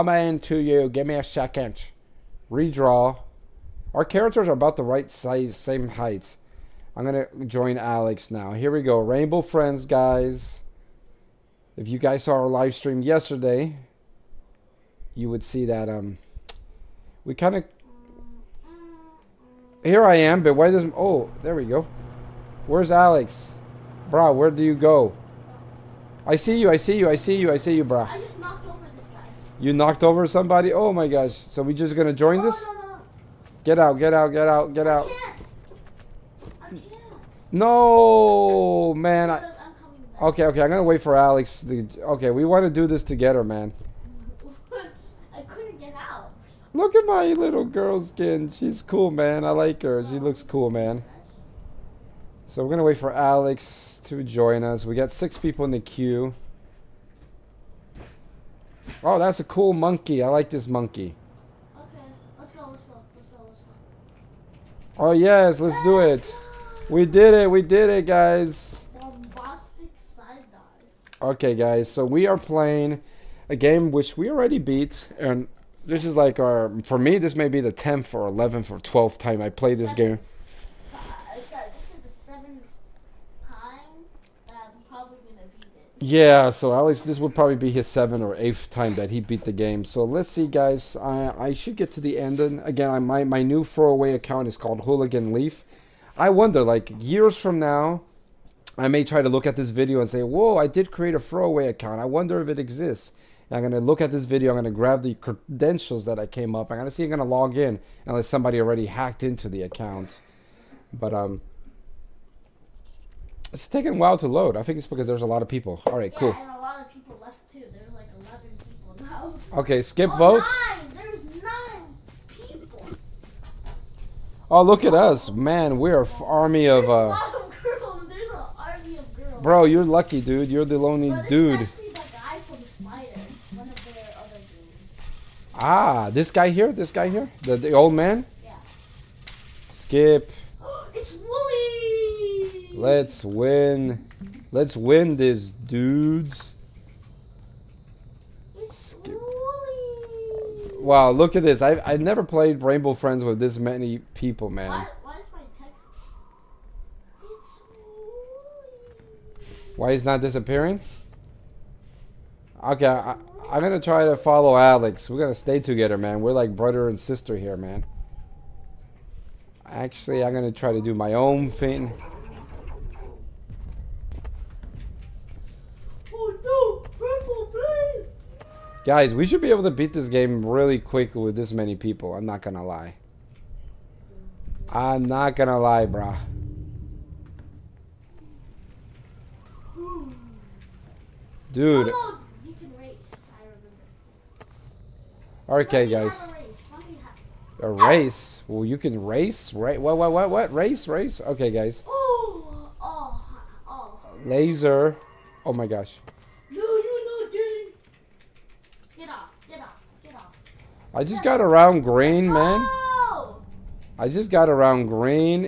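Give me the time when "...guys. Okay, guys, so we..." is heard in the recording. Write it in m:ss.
1:08.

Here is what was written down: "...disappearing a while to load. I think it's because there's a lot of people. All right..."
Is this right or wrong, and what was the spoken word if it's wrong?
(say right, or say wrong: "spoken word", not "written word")
wrong: "taking", not "disappearing".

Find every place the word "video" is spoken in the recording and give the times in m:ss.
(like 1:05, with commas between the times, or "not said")
1:39, 1:44.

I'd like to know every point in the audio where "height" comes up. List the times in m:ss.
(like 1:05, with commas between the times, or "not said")
0:05.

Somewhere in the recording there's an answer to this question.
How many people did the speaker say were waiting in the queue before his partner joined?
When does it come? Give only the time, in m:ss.
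0:55.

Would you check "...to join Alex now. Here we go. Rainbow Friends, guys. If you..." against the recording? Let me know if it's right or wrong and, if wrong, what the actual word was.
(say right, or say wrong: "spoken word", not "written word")
right.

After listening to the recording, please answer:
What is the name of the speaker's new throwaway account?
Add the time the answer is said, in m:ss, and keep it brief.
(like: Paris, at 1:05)
Hooligan Leaf, at 1:34.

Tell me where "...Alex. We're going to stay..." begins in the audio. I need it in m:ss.
2:44.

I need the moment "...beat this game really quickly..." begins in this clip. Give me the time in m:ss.
2:59.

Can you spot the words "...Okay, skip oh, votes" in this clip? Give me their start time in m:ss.
1:59.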